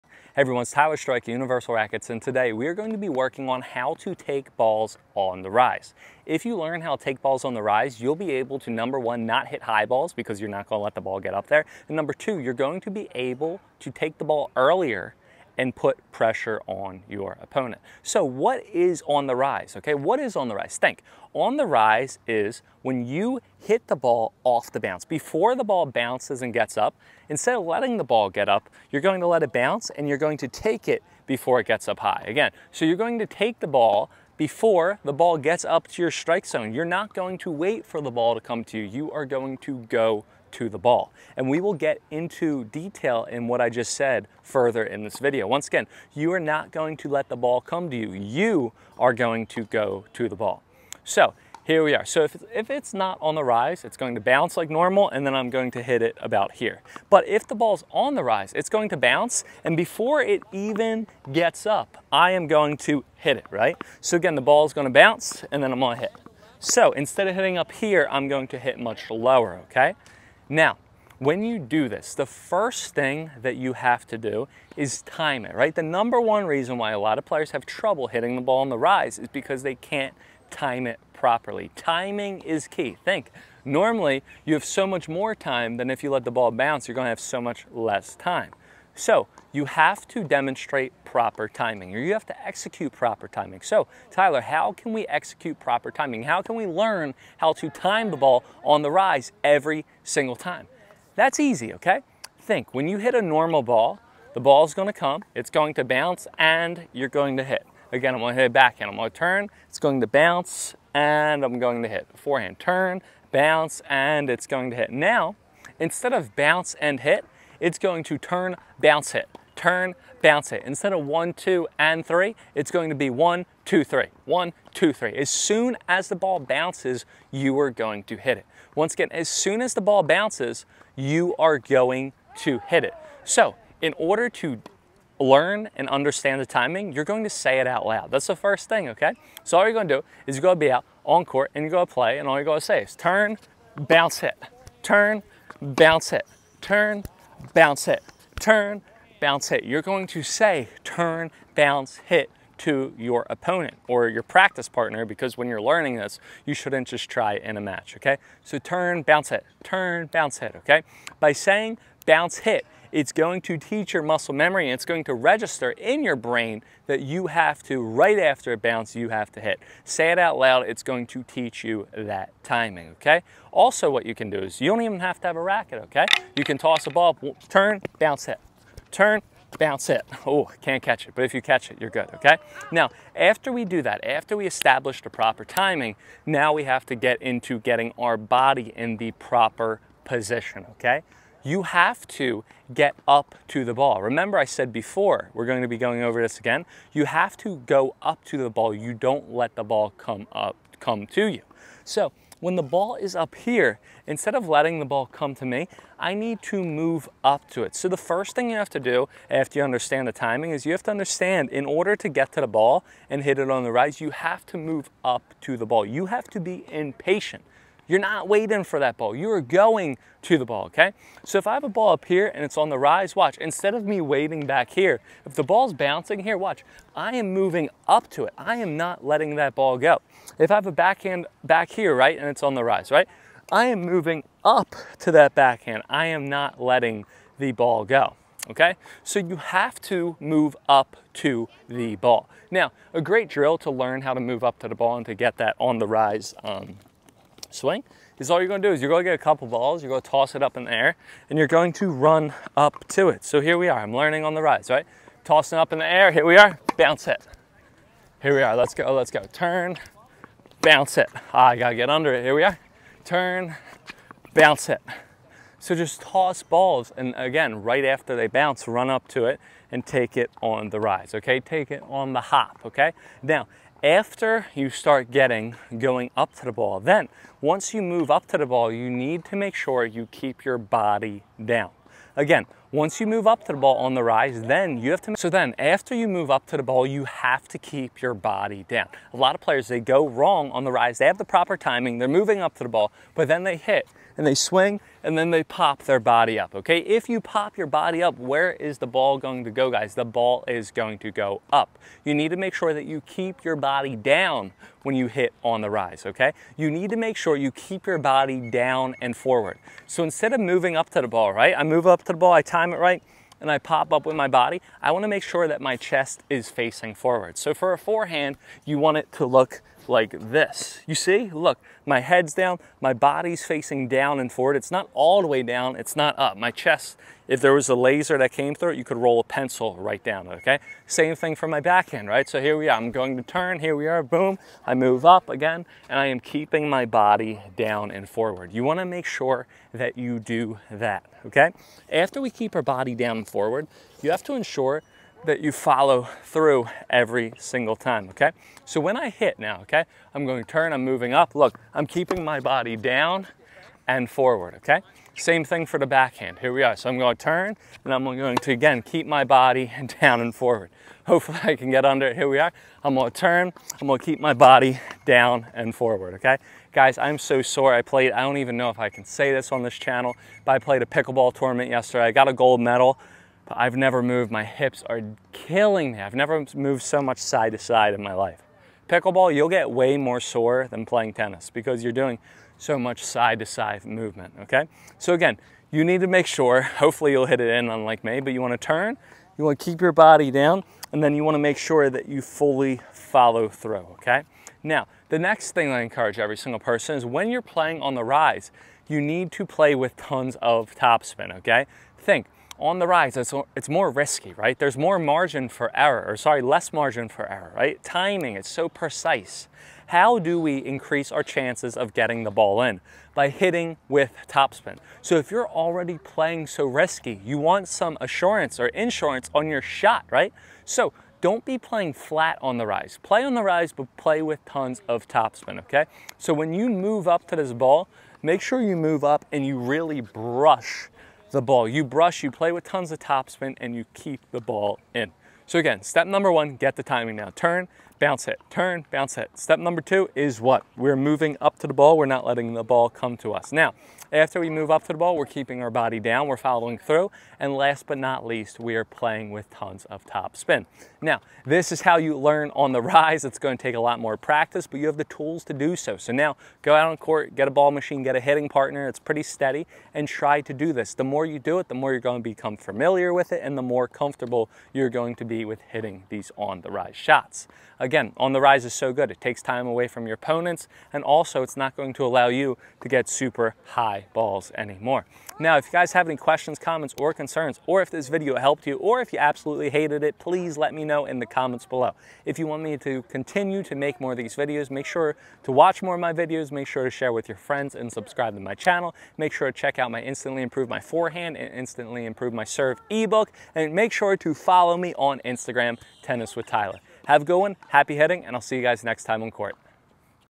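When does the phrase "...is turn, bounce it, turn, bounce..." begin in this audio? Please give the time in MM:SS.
02:22.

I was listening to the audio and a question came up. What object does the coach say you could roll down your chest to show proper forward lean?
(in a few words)
A pencil.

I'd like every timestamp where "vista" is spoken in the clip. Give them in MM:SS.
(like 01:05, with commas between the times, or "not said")
not said.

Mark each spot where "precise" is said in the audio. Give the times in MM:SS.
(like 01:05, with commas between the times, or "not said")
06:48.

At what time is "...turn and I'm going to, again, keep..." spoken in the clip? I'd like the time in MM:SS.
05:57.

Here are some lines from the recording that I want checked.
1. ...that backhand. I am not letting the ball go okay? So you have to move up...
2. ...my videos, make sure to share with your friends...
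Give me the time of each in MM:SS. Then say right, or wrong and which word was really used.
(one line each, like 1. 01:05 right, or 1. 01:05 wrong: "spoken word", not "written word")
1. 03:55 right
2. 08:06 right.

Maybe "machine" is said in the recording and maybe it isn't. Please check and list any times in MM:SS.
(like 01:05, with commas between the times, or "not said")
07:37.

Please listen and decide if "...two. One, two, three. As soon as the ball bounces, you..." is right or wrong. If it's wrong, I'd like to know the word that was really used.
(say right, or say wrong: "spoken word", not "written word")
wrong: "three", not "two".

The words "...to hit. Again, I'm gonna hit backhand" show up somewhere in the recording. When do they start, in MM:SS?
01:47.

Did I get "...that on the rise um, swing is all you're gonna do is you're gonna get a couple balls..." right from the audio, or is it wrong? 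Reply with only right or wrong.
right.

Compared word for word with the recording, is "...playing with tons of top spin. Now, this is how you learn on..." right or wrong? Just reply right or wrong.
right.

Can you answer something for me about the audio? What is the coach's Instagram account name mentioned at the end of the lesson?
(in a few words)
Tennis with Tyler.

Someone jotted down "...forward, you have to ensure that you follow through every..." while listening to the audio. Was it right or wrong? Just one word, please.
right.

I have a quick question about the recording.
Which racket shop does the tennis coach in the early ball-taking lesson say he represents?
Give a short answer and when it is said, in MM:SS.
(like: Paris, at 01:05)
Universal Rackets, at 00:01.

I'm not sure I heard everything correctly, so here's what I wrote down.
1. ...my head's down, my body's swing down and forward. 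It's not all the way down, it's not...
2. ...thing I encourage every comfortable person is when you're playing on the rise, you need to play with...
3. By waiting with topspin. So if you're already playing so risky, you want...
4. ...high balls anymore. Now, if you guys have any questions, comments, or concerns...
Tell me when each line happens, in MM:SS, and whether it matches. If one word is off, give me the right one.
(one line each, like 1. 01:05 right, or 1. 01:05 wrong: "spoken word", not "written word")
1. 05:21 wrong: "facing", not "swing"
2. 06:35 wrong: "single", not "comfortable"
3. 06:53 wrong: "hitting", not "waiting"
4. 07:53 right.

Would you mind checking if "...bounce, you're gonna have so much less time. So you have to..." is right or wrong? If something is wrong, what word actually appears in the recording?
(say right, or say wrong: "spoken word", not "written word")
right.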